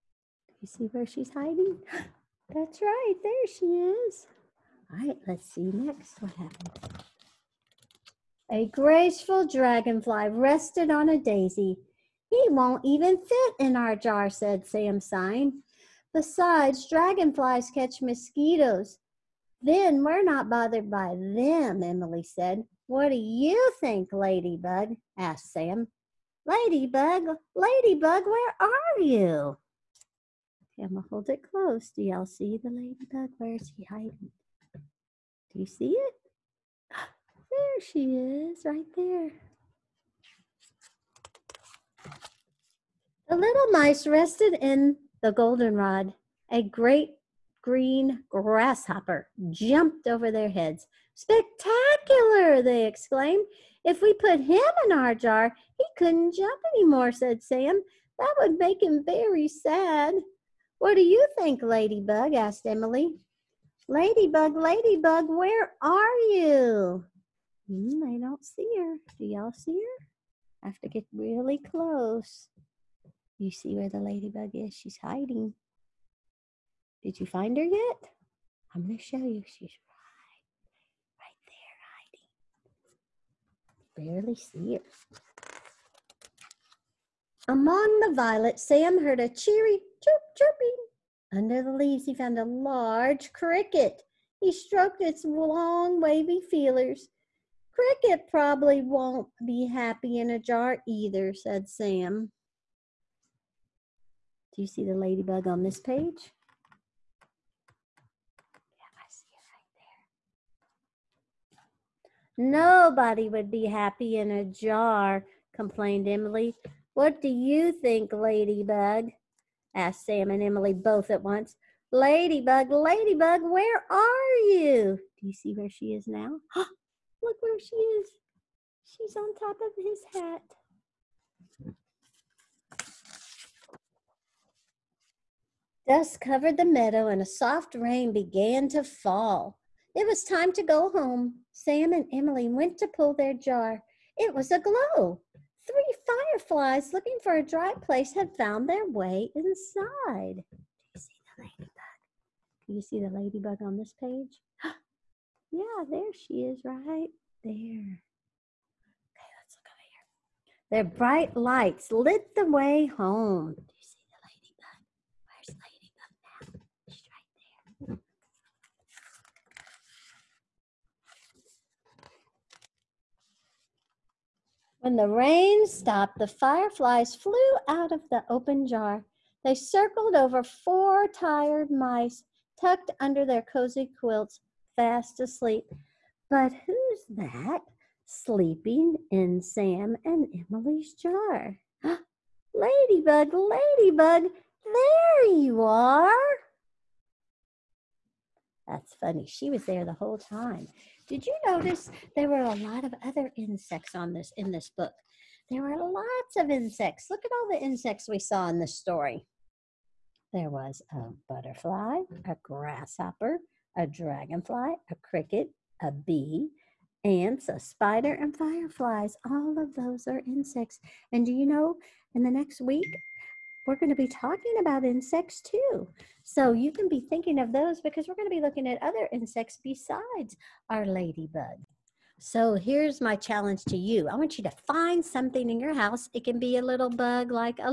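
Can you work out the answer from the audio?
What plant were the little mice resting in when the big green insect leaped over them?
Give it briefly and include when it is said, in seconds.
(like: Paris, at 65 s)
Goldenrod, at 45 s.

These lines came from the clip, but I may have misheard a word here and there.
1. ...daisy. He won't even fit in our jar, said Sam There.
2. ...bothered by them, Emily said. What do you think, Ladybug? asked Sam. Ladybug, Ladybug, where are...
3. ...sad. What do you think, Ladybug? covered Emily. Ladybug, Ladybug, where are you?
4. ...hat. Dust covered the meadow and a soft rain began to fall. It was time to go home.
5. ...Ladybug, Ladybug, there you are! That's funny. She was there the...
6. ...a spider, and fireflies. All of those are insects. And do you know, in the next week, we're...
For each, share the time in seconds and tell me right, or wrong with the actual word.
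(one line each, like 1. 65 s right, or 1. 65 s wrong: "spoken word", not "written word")
1. 11 s wrong: "Sign", not "There"
2. 20 s right
3. 59 s wrong: "asked", not "covered"
4. 130 s right
5. 192 s right
6. 217 s right.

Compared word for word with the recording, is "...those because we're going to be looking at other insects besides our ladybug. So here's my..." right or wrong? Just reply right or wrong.
right.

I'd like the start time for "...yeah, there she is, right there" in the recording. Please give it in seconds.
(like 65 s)
155 s.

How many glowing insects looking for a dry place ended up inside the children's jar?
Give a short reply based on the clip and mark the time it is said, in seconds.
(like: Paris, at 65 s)
3, at 145 s.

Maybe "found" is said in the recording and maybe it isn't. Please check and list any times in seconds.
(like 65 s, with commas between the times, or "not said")
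92 s, 148 s.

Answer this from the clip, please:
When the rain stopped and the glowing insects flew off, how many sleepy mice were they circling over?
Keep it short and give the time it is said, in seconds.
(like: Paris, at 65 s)
4, at 180 s.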